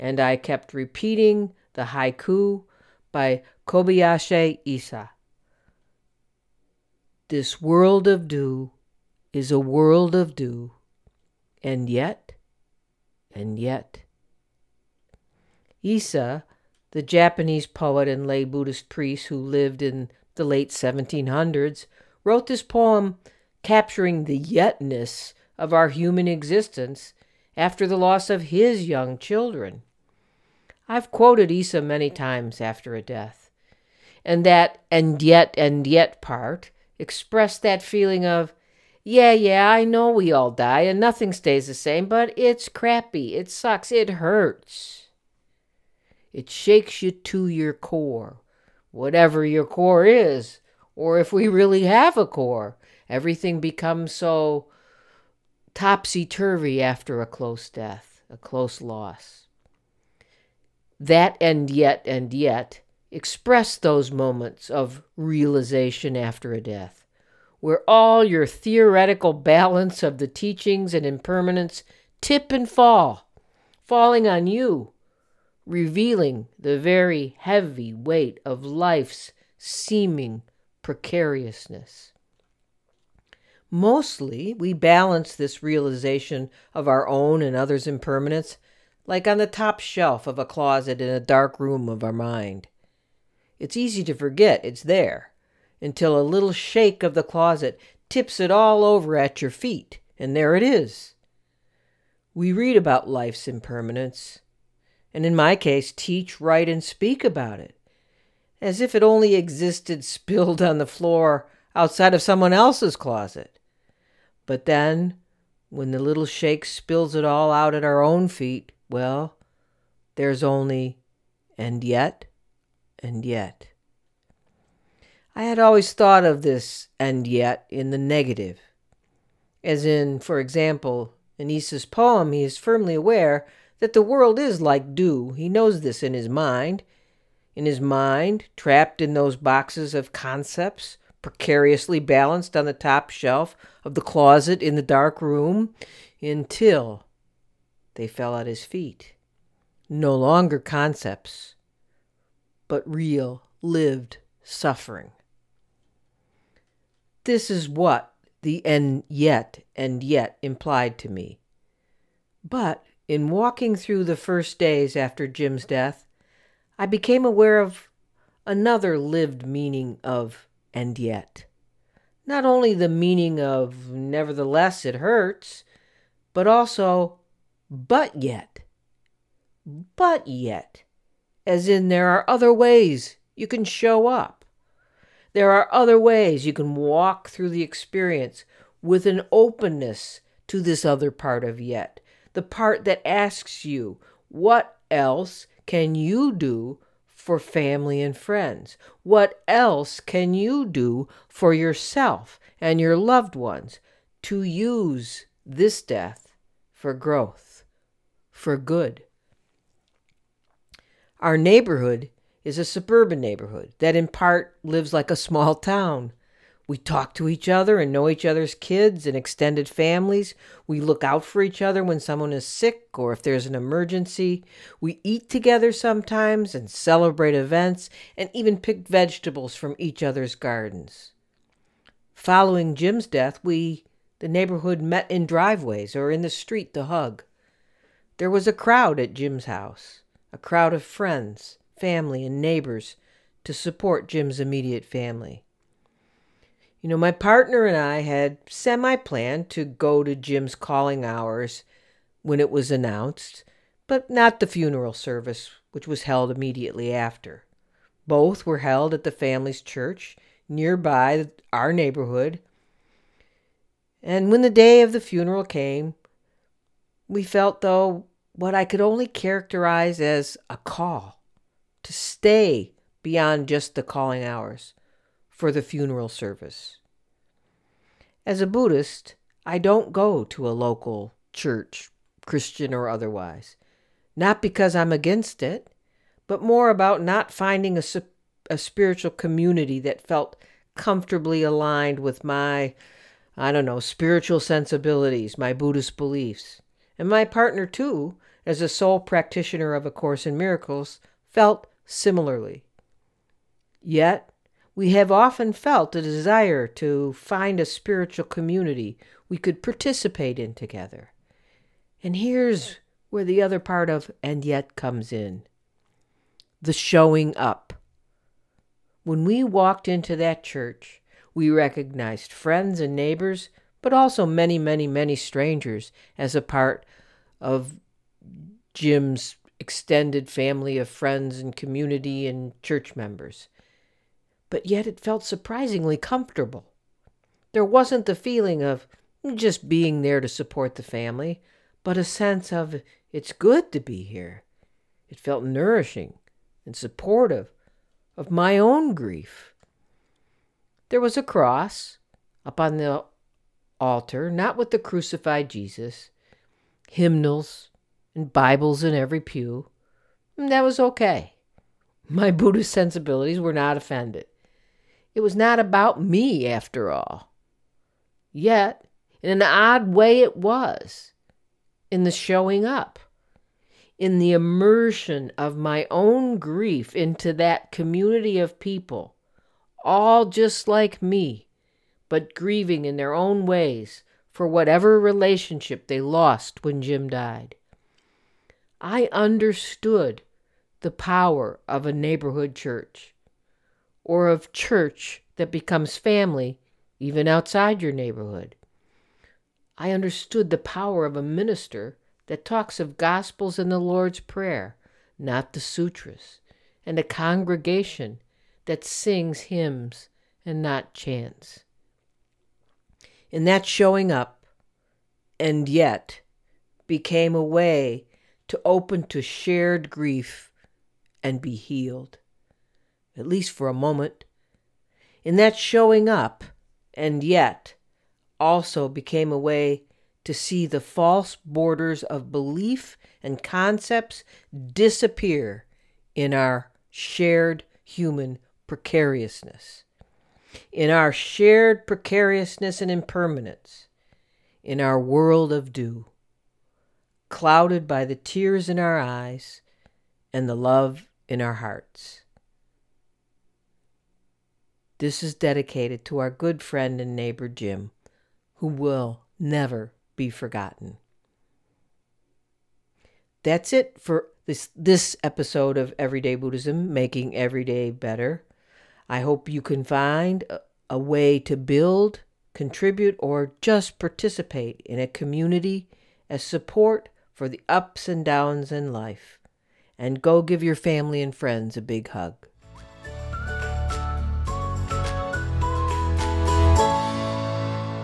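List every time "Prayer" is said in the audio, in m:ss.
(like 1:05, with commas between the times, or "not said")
6:44.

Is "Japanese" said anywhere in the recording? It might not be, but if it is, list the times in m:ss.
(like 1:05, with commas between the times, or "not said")
0:17.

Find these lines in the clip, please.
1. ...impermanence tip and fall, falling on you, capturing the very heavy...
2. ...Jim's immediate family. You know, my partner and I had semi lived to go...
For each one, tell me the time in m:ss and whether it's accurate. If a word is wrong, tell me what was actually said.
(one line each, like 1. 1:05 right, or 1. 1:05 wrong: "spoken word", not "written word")
1. 1:11 wrong: "revealing", not "capturing"
2. 4:04 wrong: "planned", not "lived".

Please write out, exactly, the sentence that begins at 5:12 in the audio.
And here's where the other part of and yet comes in the showing up.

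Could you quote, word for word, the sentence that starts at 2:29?
No longer concepts, but real, lived suffering.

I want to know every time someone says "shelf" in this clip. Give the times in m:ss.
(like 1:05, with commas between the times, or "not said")
1:29, 2:23.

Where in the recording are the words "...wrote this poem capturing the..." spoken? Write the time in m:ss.
0:22.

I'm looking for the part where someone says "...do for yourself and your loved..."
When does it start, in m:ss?
3:20.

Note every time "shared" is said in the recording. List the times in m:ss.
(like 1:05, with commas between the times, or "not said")
6:59, 7:16, 7:21.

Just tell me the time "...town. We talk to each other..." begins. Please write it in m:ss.
3:35.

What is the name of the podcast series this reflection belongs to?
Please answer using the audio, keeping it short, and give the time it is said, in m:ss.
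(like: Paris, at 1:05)
Everyday Buddhism, at 7:45.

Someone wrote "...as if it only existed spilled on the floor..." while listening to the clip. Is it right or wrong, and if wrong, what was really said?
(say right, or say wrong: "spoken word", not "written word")
right.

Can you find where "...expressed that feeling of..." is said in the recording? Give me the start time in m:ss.
0:36.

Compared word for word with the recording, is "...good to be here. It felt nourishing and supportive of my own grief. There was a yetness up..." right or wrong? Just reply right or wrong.
wrong.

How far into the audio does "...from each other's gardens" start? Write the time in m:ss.
3:49.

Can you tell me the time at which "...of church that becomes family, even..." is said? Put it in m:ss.
6:34.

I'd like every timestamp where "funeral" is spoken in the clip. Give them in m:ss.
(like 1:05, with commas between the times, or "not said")
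4:14, 4:25, 4:35.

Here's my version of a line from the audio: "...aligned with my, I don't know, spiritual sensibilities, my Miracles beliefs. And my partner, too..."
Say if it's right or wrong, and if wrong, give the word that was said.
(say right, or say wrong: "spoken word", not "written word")
wrong: "Buddhist", not "Miracles".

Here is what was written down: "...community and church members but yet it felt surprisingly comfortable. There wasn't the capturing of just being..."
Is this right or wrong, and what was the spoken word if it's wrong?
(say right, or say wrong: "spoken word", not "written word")
wrong: "feeling", not "capturing".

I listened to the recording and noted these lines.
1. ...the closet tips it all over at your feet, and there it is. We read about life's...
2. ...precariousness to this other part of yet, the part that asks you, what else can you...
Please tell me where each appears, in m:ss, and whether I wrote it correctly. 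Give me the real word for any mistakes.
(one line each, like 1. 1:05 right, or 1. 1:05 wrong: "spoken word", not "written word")
1. 1:37 right
2. 3:09 wrong: "openness", not "precariousness".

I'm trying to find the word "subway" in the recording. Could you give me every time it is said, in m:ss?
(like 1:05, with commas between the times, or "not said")
not said.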